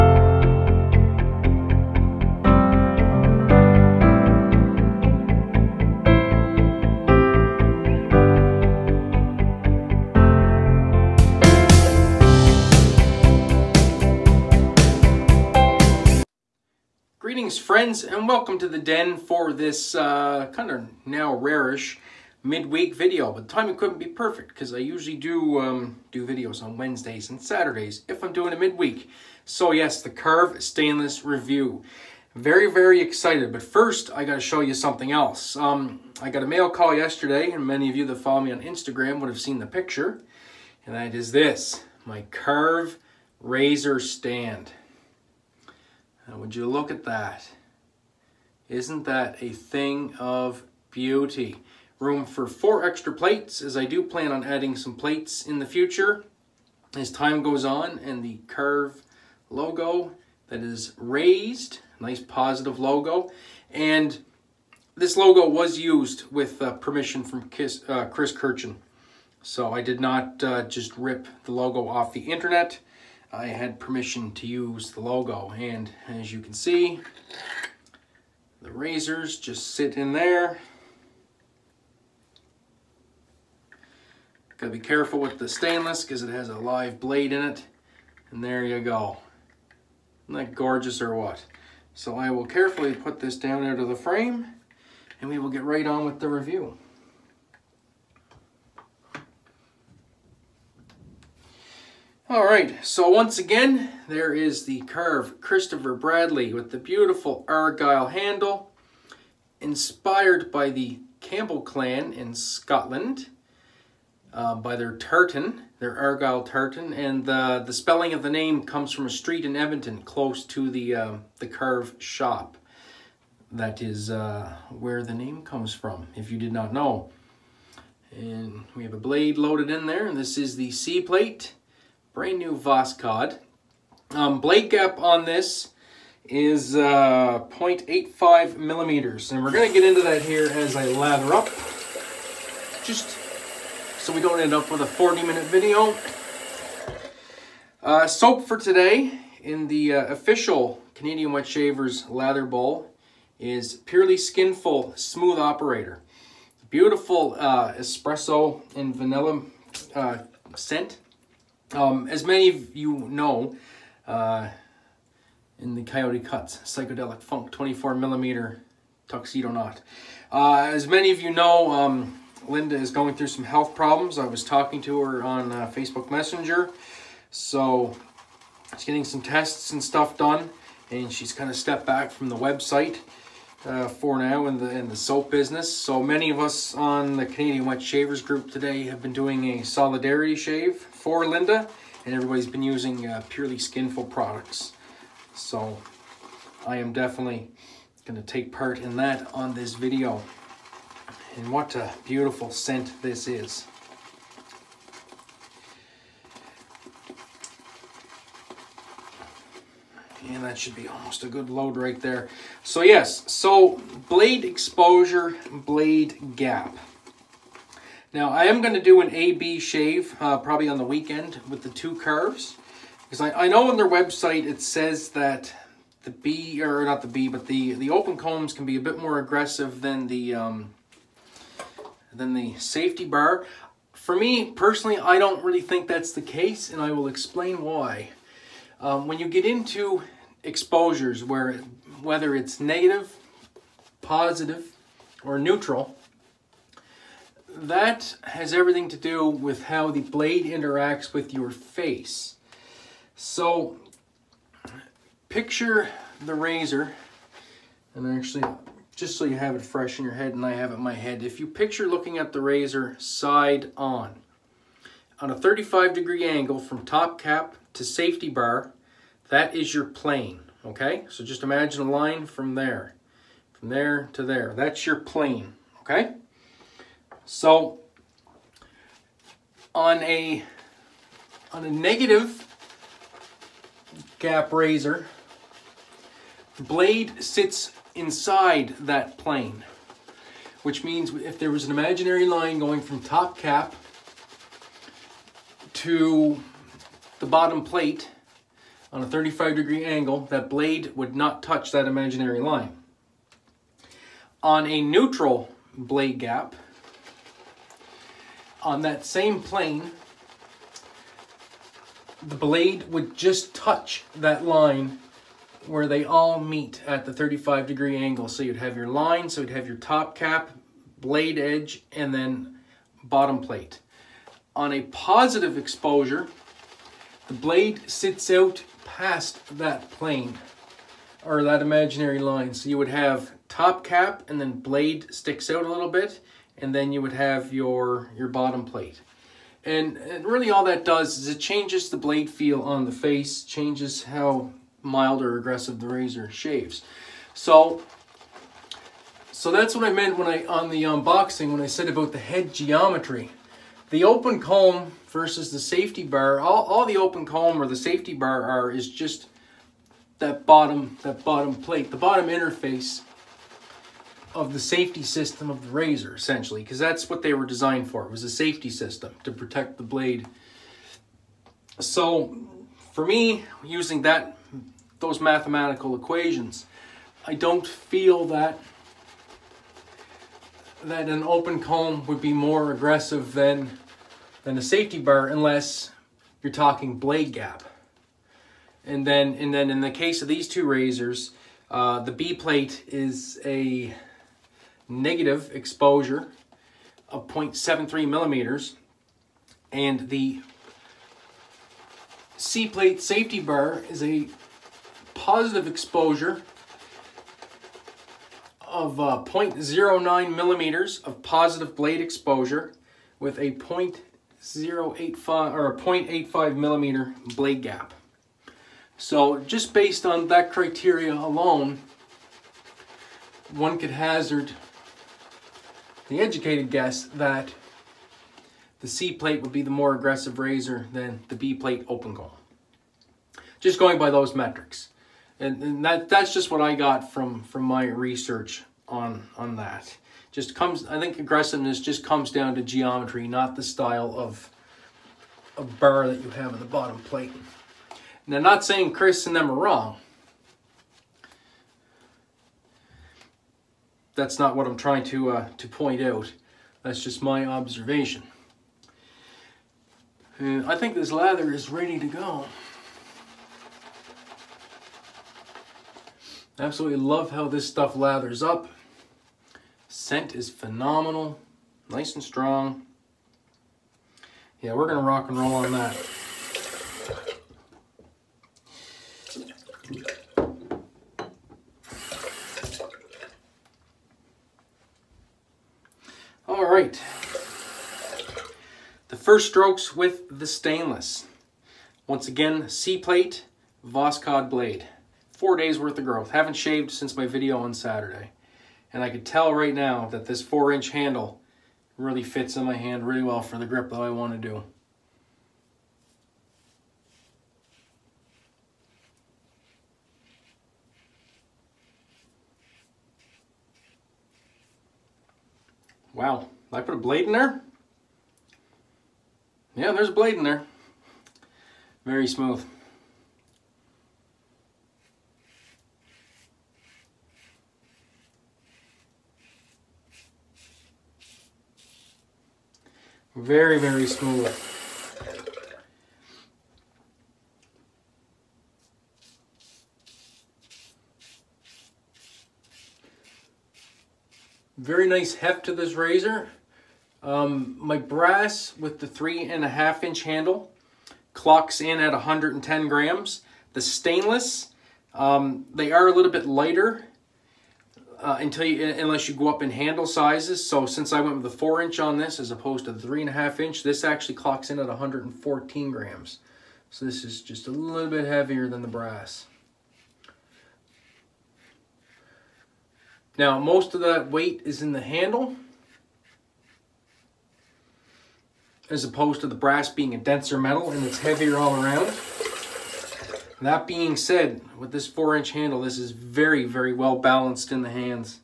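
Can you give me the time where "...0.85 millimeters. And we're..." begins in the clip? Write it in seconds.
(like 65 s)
137 s.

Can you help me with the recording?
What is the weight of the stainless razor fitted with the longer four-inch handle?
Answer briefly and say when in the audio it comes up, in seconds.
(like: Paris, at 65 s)
114 grams, at 564 s.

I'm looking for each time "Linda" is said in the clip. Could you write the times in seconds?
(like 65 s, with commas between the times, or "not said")
172 s, 191 s.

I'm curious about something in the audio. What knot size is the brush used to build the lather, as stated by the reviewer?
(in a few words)
24 millimeter.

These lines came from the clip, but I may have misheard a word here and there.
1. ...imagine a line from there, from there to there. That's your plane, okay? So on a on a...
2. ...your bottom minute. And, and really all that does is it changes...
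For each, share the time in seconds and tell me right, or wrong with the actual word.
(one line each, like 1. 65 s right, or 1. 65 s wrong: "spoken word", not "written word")
1. 271 s right
2. 338 s wrong: "plate", not "minute".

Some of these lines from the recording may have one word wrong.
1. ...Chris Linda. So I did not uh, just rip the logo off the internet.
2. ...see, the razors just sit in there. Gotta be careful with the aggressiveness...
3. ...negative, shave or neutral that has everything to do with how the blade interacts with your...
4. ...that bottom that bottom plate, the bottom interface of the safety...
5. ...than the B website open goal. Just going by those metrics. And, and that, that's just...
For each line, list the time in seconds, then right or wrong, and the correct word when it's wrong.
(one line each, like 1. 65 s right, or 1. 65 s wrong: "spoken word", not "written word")
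1. 68 s wrong: "Kirchen", not "Linda"
2. 76 s wrong: "stainless", not "aggressiveness"
3. 242 s wrong: "positive", not "shave"
4. 360 s right
5. 430 s wrong: "plate", not "website".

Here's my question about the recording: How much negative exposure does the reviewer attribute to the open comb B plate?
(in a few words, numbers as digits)
0.73 millimeters.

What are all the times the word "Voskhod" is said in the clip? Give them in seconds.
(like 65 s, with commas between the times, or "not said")
132 s, 493 s.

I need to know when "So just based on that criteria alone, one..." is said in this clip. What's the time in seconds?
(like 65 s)
418 s.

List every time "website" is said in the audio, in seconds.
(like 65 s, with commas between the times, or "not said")
182 s, 223 s.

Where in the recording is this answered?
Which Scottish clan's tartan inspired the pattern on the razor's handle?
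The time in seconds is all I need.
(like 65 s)
111 s.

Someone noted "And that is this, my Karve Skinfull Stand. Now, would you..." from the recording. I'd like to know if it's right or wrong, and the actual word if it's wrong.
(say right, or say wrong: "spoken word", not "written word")
wrong: "Razor", not "Skinfull".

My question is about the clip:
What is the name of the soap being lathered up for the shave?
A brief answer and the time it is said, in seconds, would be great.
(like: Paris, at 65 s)
Smooth Operator, at 154 s.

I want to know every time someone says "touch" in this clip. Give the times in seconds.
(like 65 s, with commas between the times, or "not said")
301 s, 313 s.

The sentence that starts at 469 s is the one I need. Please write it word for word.
Scent is phenomenal, nice and strong.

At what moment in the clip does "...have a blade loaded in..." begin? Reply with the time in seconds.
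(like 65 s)
128 s.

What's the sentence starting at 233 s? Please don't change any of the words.
For me personally I don't really think that's the case and I will explain why.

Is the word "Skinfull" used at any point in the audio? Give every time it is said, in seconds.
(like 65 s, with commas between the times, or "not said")
154 s, 193 s.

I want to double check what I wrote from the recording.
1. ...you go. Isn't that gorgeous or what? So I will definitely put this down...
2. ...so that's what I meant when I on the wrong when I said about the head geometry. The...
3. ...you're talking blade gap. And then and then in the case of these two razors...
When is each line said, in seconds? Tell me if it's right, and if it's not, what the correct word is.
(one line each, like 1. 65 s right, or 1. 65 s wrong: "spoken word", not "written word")
1. 88 s wrong: "carefully", not "definitely"
2. 349 s wrong: "unboxing", not "wrong"
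3. 386 s right.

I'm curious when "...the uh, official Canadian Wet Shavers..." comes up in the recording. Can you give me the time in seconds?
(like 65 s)
149 s.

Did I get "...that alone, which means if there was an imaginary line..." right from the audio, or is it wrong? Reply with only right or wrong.
wrong.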